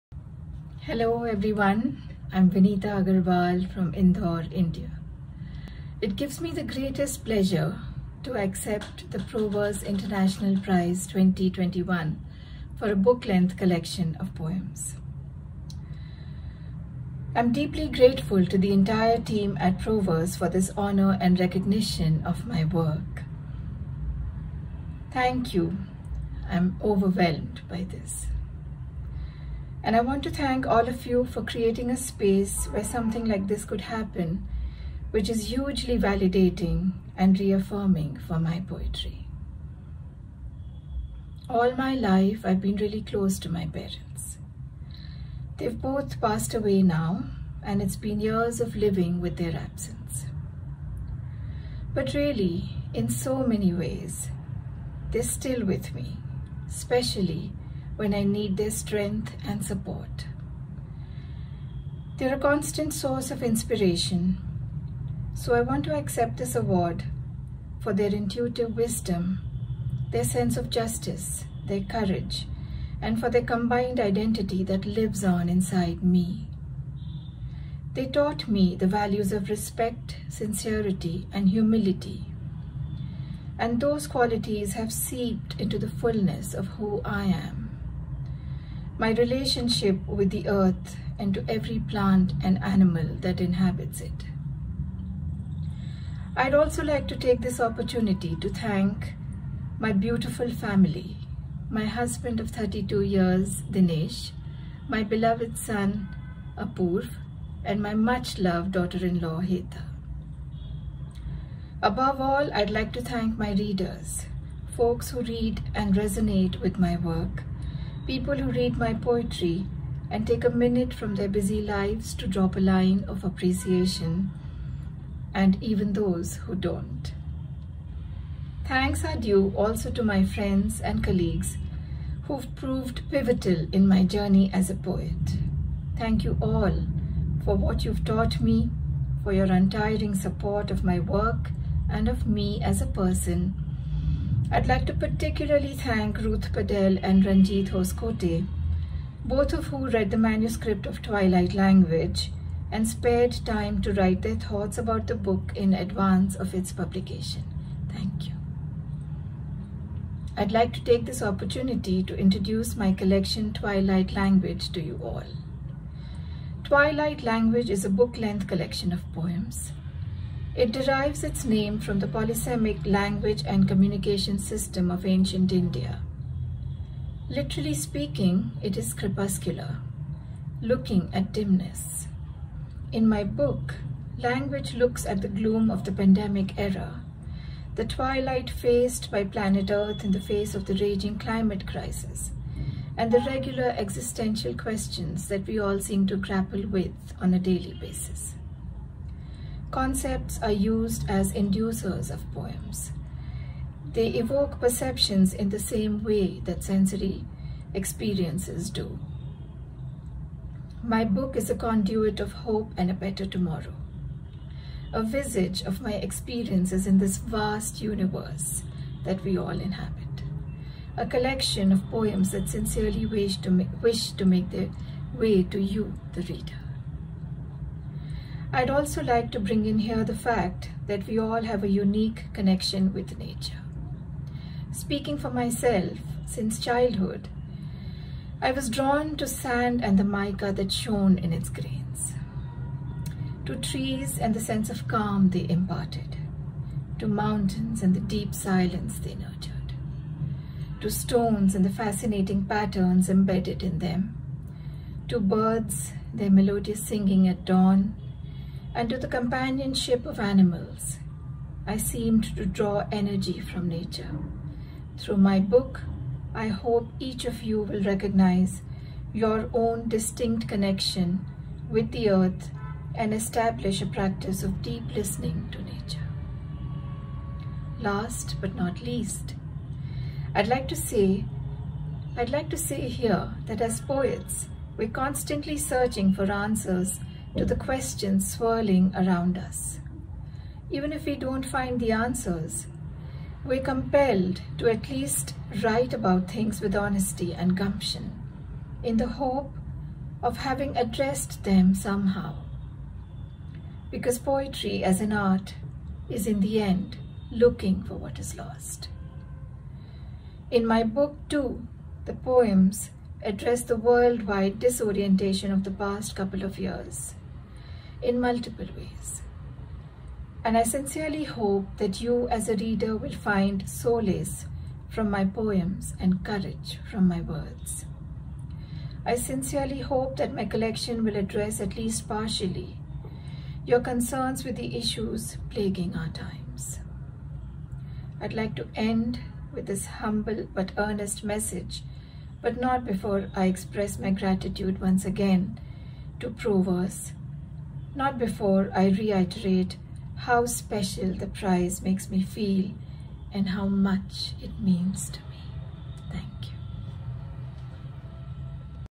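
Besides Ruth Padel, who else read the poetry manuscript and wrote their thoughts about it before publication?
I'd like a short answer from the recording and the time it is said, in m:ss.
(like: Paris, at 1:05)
Ranjit Hoskote, at 2:27.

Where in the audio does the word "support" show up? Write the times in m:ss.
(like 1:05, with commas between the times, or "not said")
0:59, 2:20.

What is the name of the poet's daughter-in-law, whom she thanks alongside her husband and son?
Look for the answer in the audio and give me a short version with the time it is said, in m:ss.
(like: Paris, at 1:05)
Heta, at 1:49.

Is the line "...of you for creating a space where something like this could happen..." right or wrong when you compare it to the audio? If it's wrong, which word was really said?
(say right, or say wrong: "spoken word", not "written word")
right.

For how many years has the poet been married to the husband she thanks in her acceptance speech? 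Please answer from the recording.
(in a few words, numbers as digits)
32.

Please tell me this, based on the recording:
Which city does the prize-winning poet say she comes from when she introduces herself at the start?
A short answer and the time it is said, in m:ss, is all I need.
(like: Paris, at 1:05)
Indore, at 0:03.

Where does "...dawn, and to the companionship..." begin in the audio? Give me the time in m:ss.
4:17.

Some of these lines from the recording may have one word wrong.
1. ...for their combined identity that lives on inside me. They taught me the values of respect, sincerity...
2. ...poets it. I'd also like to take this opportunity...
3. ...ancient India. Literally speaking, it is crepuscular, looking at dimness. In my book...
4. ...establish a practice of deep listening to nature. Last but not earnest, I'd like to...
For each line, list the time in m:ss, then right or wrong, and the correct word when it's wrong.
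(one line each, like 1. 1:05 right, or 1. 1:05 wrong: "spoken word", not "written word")
1. 1:13 right
2. 1:33 wrong: "inhabits", not "poets"
3. 2:55 right
4. 4:33 wrong: "least", not "earnest".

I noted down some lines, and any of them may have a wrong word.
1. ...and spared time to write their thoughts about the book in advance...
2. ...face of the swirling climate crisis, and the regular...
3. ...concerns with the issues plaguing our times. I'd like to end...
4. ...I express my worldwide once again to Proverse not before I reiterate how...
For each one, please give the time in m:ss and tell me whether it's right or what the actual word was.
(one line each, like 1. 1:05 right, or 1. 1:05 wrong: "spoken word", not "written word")
1. 2:32 right
2. 3:10 wrong: "raging", not "swirling"
3. 5:33 right
4. 5:43 wrong: "gratitude", not "worldwide".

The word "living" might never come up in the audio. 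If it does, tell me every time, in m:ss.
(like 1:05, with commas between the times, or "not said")
0:48.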